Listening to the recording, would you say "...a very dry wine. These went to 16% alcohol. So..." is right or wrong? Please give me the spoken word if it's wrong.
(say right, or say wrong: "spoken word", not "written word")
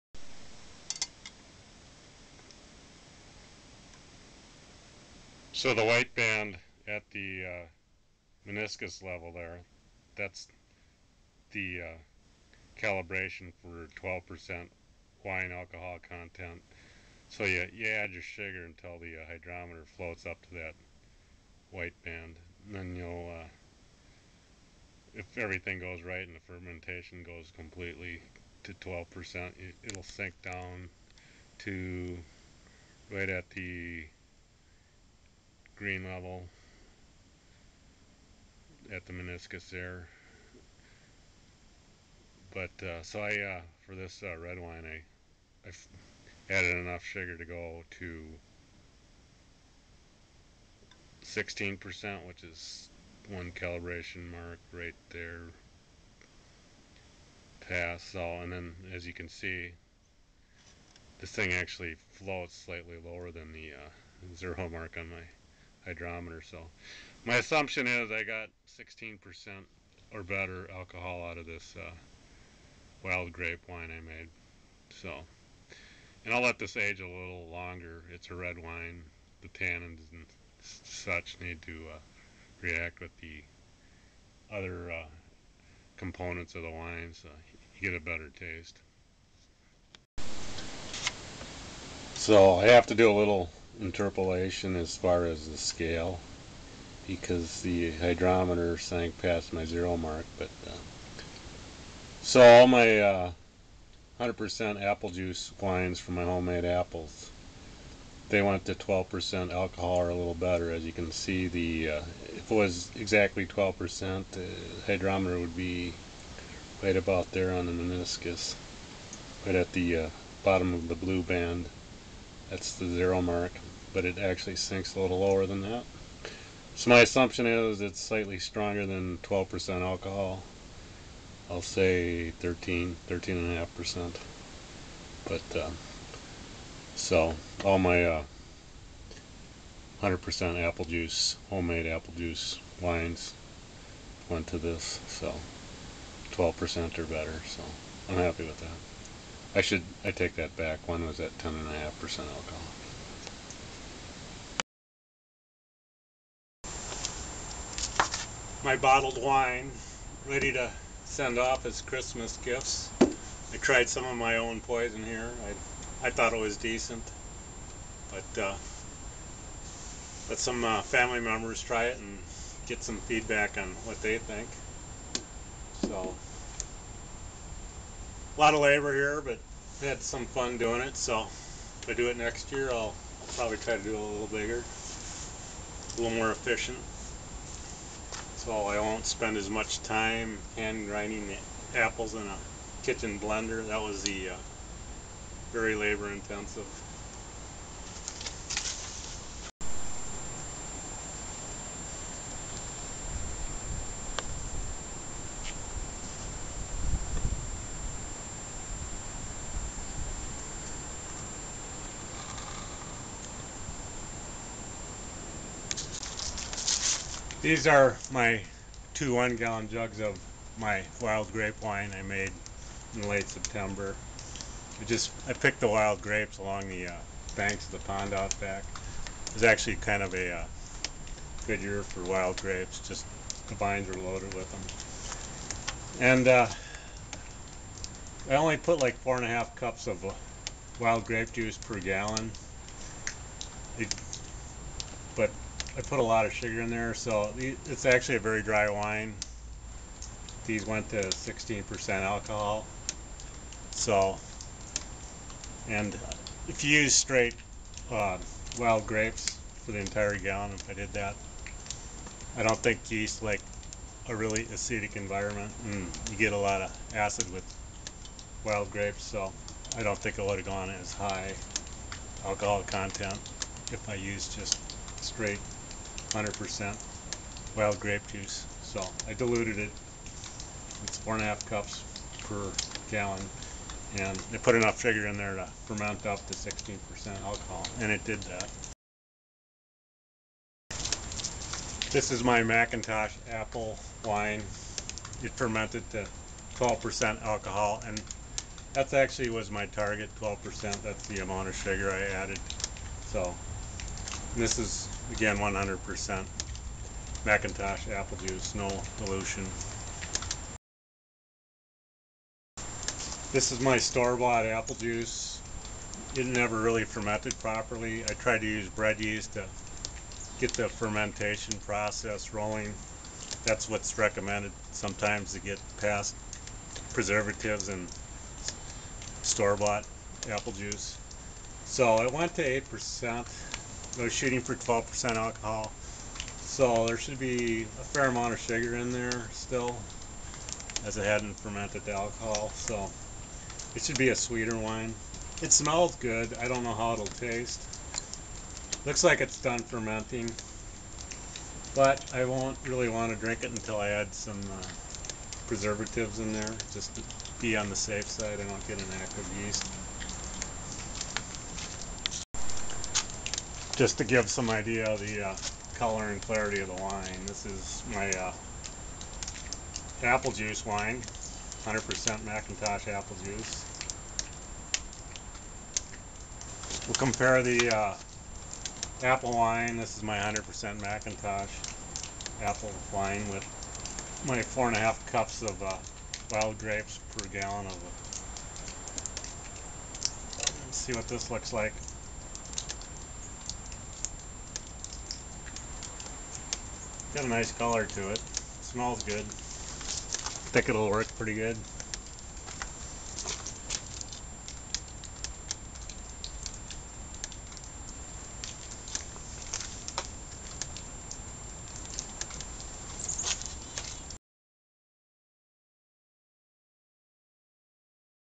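right.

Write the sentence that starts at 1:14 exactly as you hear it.
So, and I'll let this age a little longer.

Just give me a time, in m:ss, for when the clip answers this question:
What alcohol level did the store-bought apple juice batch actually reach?
5:32.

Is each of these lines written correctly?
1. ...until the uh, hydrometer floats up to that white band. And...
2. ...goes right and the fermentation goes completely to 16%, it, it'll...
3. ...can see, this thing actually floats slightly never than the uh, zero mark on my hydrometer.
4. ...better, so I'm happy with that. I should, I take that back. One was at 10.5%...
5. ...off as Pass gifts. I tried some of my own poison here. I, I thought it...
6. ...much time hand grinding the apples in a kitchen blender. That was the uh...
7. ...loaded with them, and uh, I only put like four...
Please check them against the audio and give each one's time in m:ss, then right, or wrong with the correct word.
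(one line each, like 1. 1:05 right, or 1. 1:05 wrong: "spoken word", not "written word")
1. 0:18 right
2. 0:25 wrong: "12", not "16"
3. 0:59 wrong: "lower", not "never"
4. 2:27 right
5. 2:41 wrong: "Christmas", not "Pass"
6. 3:09 right
7. 3:54 right.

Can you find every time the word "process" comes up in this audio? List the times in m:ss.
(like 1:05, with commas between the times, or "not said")
5:21.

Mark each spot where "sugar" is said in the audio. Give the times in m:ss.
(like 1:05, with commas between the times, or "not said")
0:18, 0:47, 4:06, 4:44, 5:01, 5:38.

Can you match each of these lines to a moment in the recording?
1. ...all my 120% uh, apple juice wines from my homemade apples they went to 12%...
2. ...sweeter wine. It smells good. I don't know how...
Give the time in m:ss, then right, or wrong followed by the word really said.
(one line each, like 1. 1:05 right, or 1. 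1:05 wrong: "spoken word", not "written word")
1. 1:42 wrong: "100", not "120"
2. 5:44 right.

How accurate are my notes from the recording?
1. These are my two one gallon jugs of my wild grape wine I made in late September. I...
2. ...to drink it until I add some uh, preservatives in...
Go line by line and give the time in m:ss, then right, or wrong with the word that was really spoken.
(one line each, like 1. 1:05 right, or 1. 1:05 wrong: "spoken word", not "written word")
1. 3:37 right
2. 5:53 right.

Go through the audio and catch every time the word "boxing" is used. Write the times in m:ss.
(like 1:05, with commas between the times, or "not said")
not said.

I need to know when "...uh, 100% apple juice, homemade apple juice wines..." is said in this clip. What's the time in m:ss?
2:18.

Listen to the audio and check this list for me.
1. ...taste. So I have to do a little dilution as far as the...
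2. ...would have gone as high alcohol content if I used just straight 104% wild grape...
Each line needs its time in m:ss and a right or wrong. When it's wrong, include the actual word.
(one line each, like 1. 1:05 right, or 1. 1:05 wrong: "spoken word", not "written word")
1. 1:28 wrong: "interpolation", not "dilution"
2. 4:30 wrong: "100", not "104".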